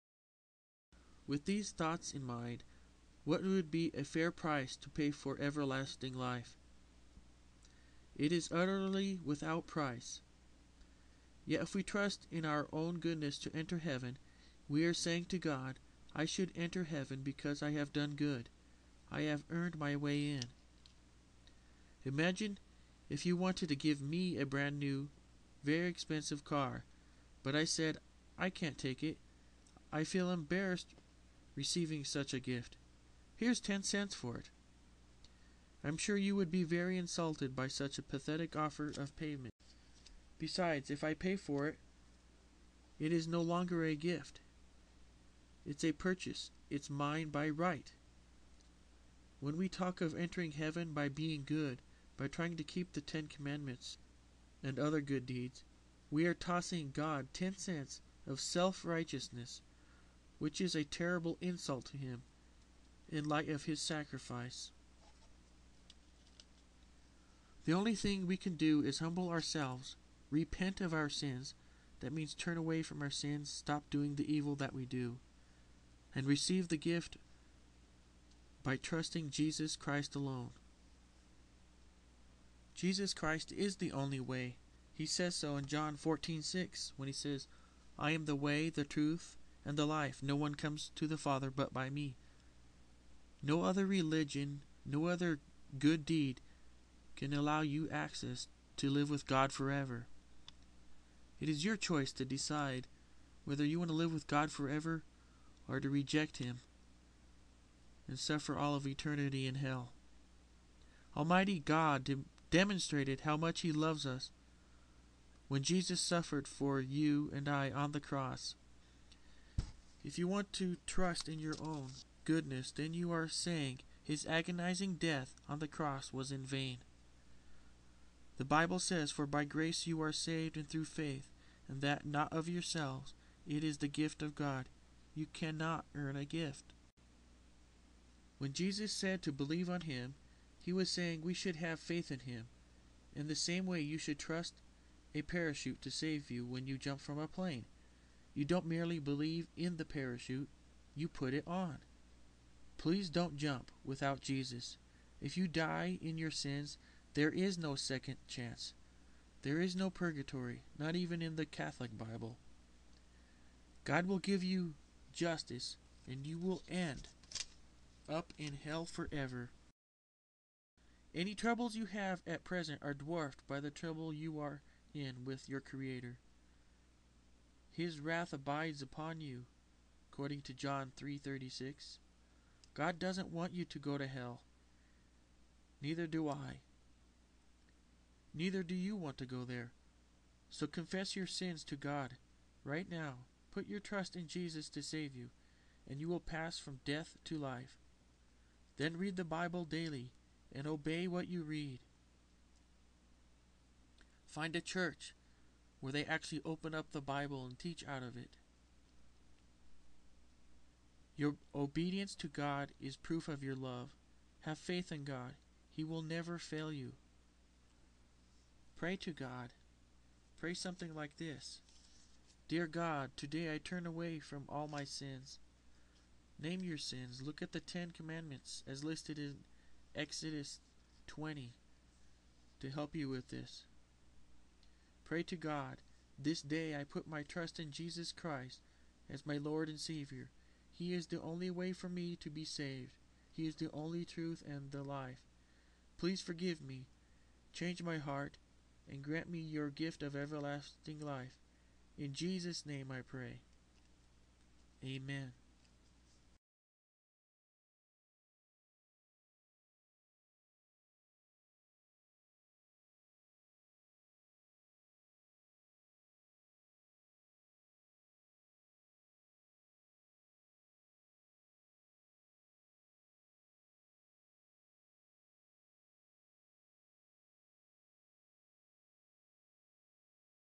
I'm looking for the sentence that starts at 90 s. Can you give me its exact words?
No one comes to the Father but by me.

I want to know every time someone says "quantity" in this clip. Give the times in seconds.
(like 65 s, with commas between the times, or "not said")
not said.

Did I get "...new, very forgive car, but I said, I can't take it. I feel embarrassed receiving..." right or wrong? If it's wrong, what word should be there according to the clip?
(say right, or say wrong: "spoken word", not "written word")
wrong: "expensive", not "forgive".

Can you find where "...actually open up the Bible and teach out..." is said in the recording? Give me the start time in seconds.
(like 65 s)
206 s.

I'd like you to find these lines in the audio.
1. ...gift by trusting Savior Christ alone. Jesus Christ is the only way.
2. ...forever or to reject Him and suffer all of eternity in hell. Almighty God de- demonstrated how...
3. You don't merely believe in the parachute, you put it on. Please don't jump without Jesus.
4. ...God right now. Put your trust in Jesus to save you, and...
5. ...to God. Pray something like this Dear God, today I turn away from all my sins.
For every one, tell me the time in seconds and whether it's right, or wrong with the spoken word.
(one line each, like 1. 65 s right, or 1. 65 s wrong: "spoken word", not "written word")
1. 76 s wrong: "Jesus", not "Savior"
2. 104 s right
3. 148 s right
4. 191 s right
5. 218 s right.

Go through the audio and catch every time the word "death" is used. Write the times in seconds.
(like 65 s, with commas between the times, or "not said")
124 s, 196 s.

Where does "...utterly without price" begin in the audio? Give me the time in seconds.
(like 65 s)
8 s.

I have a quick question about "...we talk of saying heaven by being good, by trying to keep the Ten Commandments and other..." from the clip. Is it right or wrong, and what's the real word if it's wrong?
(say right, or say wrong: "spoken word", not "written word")
wrong: "entering", not "saying".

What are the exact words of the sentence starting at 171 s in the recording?
Any troubles you have at present are dwarfed by the trouble you are in with your Creator.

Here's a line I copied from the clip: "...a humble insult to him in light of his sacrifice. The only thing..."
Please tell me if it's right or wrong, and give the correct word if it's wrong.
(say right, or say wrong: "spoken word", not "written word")
wrong: "terrible", not "humble".